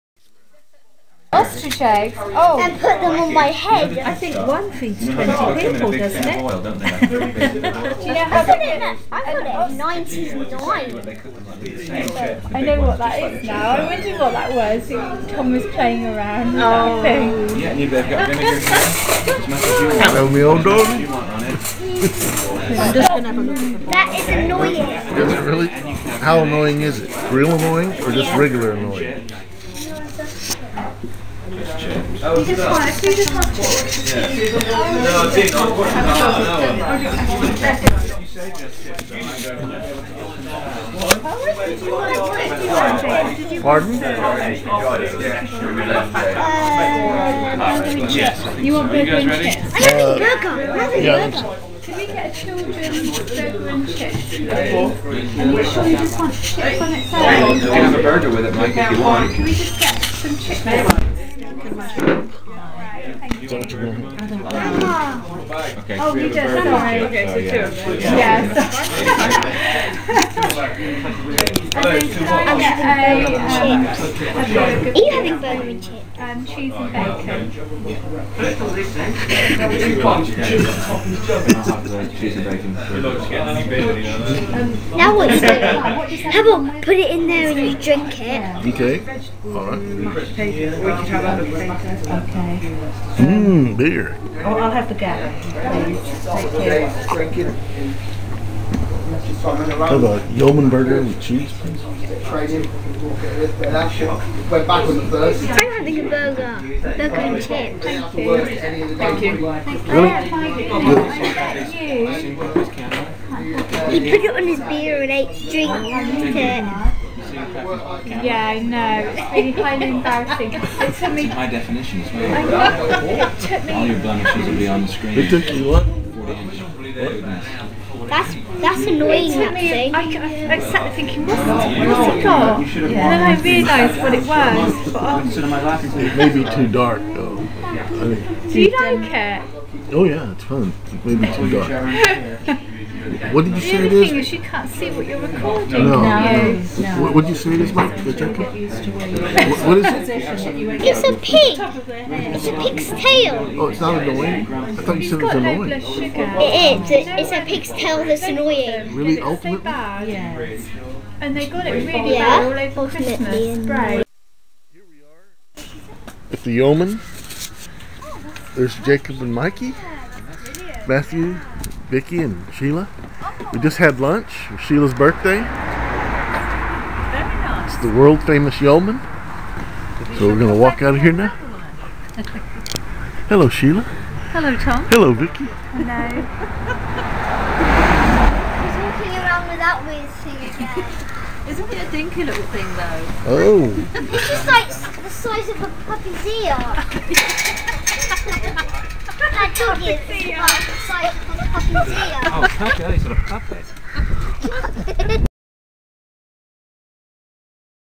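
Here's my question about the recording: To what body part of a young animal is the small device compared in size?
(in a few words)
A puppy's ear.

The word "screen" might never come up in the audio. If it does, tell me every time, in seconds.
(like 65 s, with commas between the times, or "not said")
124 s.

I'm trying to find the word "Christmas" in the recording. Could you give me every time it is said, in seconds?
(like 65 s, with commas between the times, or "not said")
162 s.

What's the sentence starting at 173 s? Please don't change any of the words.
We just had lunch for Sheila's birthday.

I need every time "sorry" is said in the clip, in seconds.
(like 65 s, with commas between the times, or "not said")
66 s.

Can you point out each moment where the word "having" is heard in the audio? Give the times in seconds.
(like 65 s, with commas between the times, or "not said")
49 s, 75 s, 105 s.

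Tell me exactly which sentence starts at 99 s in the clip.
How about Yeoman burger with cheese, please?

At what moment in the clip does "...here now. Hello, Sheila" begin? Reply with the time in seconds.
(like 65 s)
181 s.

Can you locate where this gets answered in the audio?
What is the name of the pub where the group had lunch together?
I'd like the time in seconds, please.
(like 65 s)
166 s.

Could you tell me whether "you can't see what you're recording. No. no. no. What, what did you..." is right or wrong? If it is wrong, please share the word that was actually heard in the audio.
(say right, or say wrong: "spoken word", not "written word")
right.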